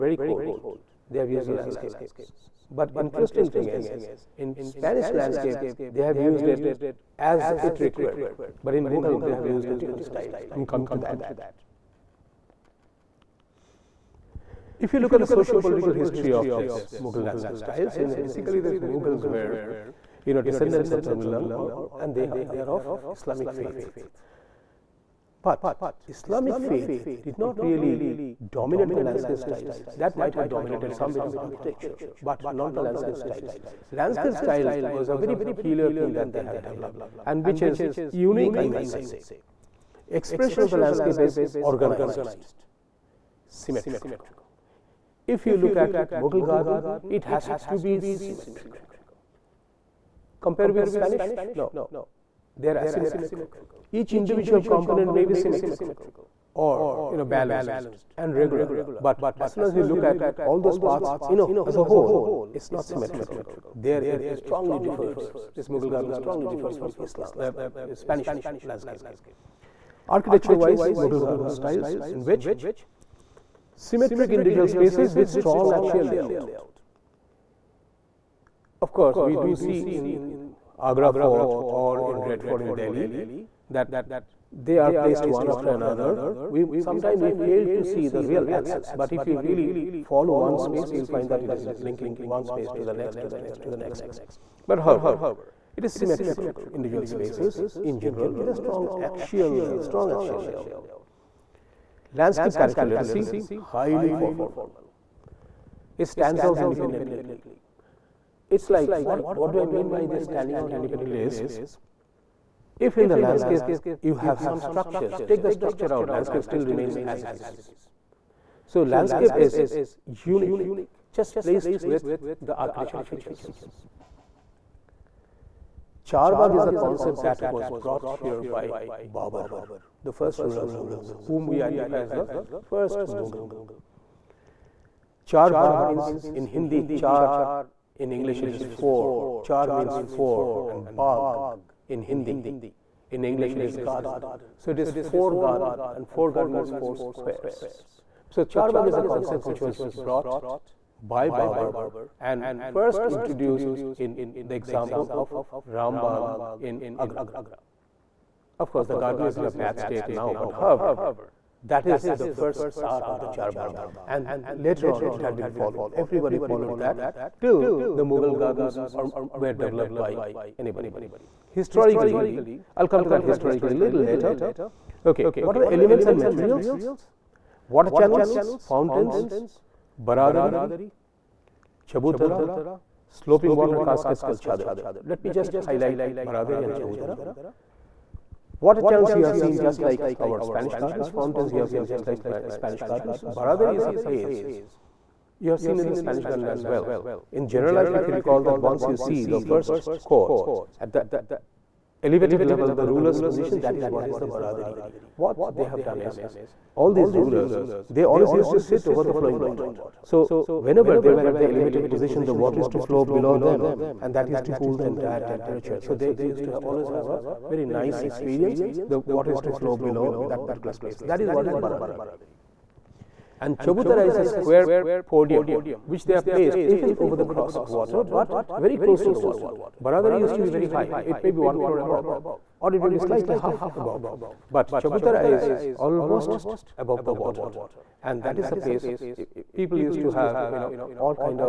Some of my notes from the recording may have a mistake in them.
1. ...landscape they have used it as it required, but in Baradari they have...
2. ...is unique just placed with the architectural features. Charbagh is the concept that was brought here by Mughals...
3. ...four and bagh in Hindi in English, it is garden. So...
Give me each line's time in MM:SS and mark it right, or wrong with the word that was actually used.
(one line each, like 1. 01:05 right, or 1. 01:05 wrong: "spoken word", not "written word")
1. 00:05 wrong: "Mughal", not "Baradari"
2. 01:59 wrong: "Babur", not "Mughals"
3. 02:20 right.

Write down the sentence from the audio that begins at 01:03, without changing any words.
There it strongly differs this Mughal garden strongly differs from Islam uh, Spanish landscape.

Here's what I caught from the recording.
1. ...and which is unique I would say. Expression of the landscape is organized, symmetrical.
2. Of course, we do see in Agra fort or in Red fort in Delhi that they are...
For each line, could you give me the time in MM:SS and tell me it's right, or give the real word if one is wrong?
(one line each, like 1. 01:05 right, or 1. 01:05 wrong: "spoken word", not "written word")
1. 00:37 right
2. 01:18 right.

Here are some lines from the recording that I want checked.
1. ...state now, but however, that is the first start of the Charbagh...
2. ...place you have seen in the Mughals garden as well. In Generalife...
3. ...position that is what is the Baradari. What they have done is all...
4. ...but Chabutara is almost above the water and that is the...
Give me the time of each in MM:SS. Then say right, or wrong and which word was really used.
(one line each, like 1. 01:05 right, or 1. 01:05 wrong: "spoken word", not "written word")
1. 02:39 right
2. 03:13 wrong: "Spanish", not "Mughals"
3. 03:23 right
4. 03:54 right.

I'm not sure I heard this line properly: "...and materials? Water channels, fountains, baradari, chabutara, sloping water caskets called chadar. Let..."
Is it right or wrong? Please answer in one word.
right.